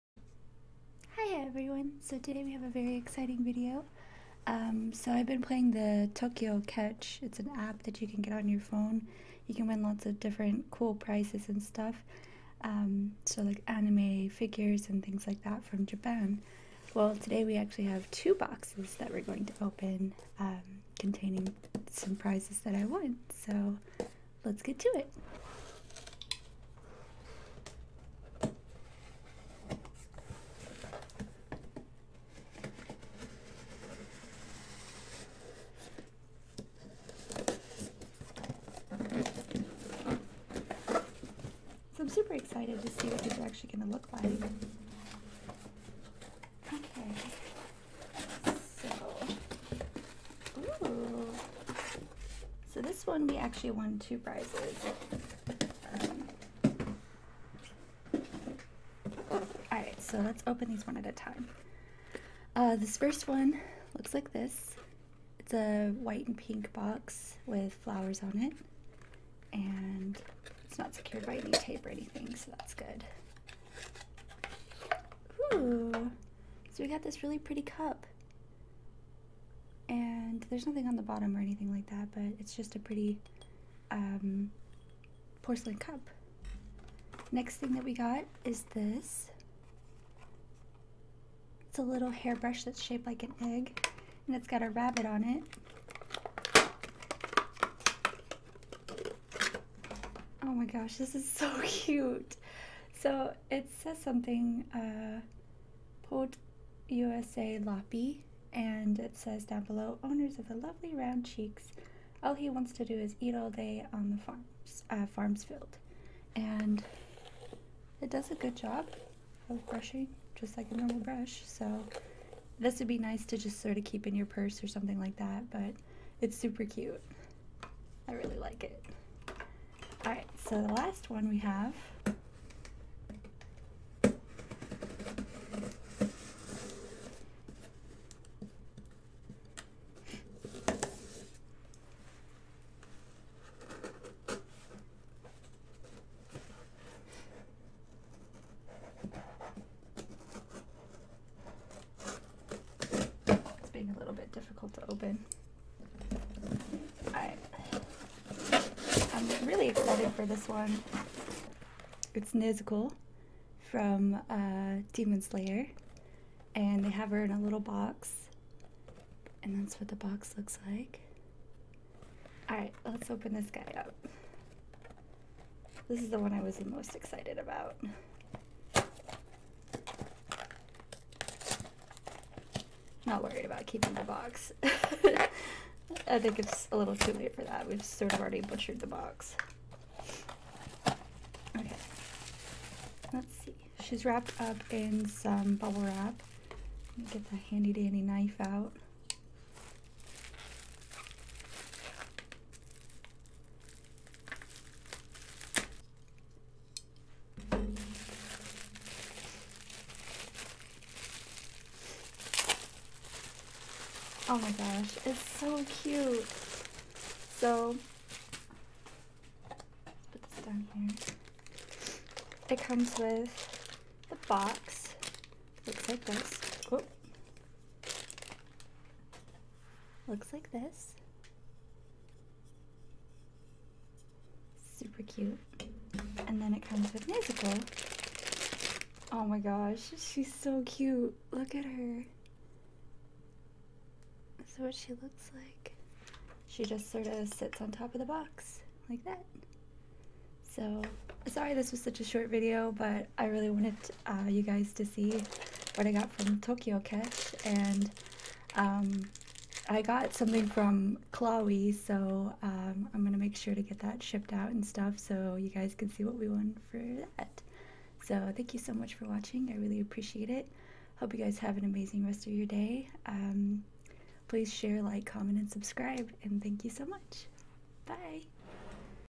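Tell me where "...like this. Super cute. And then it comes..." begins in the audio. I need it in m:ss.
3:50.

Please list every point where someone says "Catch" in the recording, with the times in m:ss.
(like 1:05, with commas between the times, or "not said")
0:06, 4:16.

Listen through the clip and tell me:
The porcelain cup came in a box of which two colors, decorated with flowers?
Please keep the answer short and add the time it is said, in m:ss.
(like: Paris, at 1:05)
White and pink, at 1:06.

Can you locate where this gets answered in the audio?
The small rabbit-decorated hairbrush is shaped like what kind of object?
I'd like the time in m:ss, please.
1:33.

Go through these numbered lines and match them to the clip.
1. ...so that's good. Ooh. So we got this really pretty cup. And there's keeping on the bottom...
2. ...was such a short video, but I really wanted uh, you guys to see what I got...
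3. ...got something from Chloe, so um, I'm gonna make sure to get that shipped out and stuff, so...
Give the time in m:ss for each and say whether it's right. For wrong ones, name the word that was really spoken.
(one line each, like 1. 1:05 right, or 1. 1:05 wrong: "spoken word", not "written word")
1. 1:12 wrong: "nothing", not "keeping"
2. 4:11 right
3. 4:19 right.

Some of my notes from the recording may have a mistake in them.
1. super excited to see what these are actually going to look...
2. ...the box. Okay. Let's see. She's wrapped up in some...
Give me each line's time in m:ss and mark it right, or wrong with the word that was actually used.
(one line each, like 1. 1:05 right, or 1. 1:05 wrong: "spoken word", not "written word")
1. 0:42 right
2. 3:08 right.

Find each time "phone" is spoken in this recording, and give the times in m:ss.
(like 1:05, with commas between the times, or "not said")
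0:08.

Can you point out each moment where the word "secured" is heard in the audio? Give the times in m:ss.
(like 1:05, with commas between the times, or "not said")
1:10.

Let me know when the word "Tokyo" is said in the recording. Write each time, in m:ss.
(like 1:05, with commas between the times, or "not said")
0:06, 4:16.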